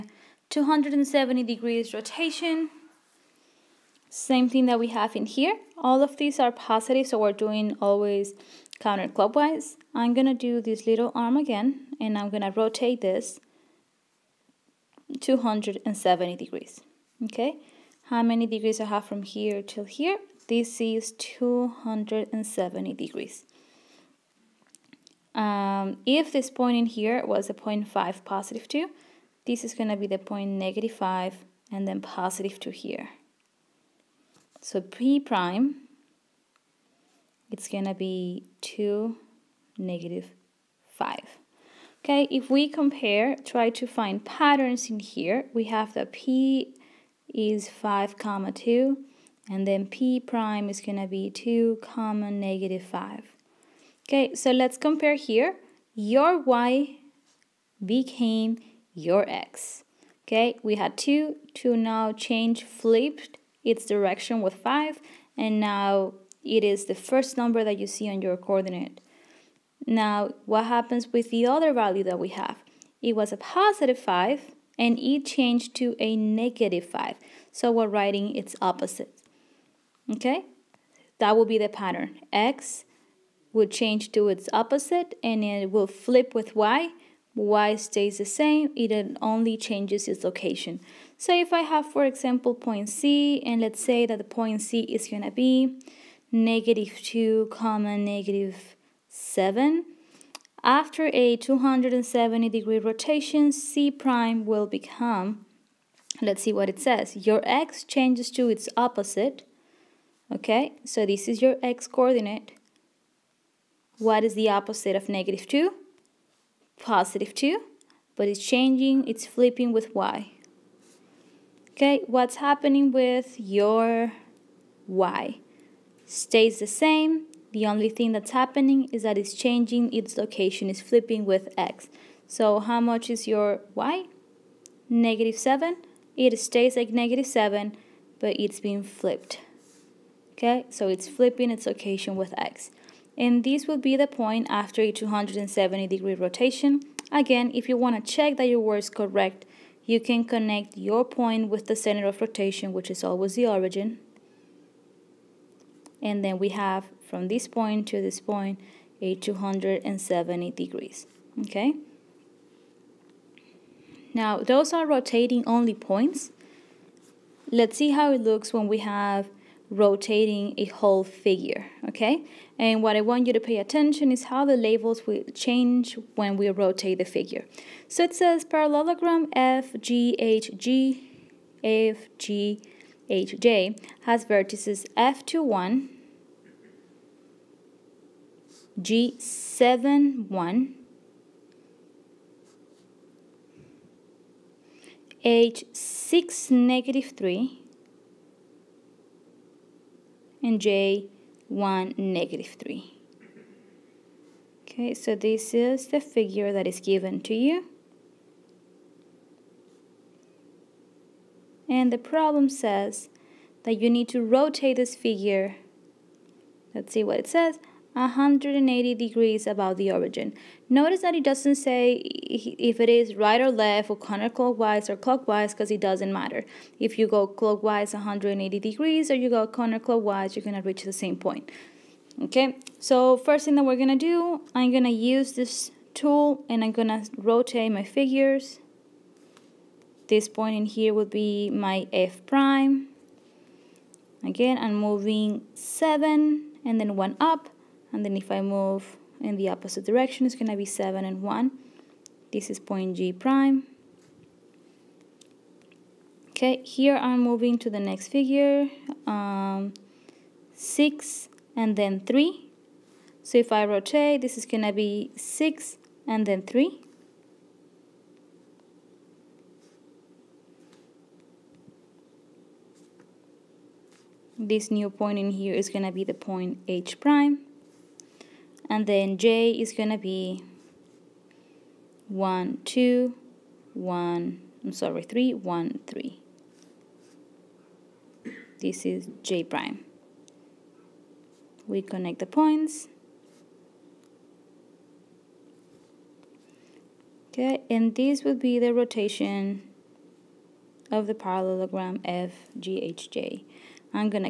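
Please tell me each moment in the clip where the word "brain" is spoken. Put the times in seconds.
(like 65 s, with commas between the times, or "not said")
not said.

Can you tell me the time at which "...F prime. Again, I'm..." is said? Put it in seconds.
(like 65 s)
241 s.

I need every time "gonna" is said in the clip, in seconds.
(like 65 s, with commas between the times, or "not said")
37 s, 50 s, 279 s.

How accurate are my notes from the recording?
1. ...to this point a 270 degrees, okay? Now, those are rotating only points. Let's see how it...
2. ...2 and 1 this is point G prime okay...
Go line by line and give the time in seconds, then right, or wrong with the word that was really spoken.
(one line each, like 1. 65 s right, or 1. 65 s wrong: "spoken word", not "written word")
1. 157 s right
2. 250 s wrong: "7", not "2".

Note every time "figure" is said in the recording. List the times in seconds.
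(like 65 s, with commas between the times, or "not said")
171 s, 177 s, 205 s, 215 s, 237 s, 258 s.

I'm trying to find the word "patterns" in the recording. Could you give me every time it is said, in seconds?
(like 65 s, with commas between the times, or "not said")
44 s, 81 s.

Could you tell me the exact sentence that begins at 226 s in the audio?
If you go clockwise 180 degrees or you go counterclockwise, you're going to reach the same point.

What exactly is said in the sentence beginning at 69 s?
Now, what happens with the other value that we have?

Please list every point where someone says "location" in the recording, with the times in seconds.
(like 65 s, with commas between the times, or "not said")
90 s, 130 s, 141 s.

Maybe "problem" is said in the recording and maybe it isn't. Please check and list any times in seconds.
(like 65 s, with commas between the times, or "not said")
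212 s.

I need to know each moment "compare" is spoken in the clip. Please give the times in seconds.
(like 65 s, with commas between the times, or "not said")
42 s, 54 s.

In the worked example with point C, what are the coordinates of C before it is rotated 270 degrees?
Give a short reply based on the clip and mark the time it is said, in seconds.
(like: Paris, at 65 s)
(-2, -7), at 96 s.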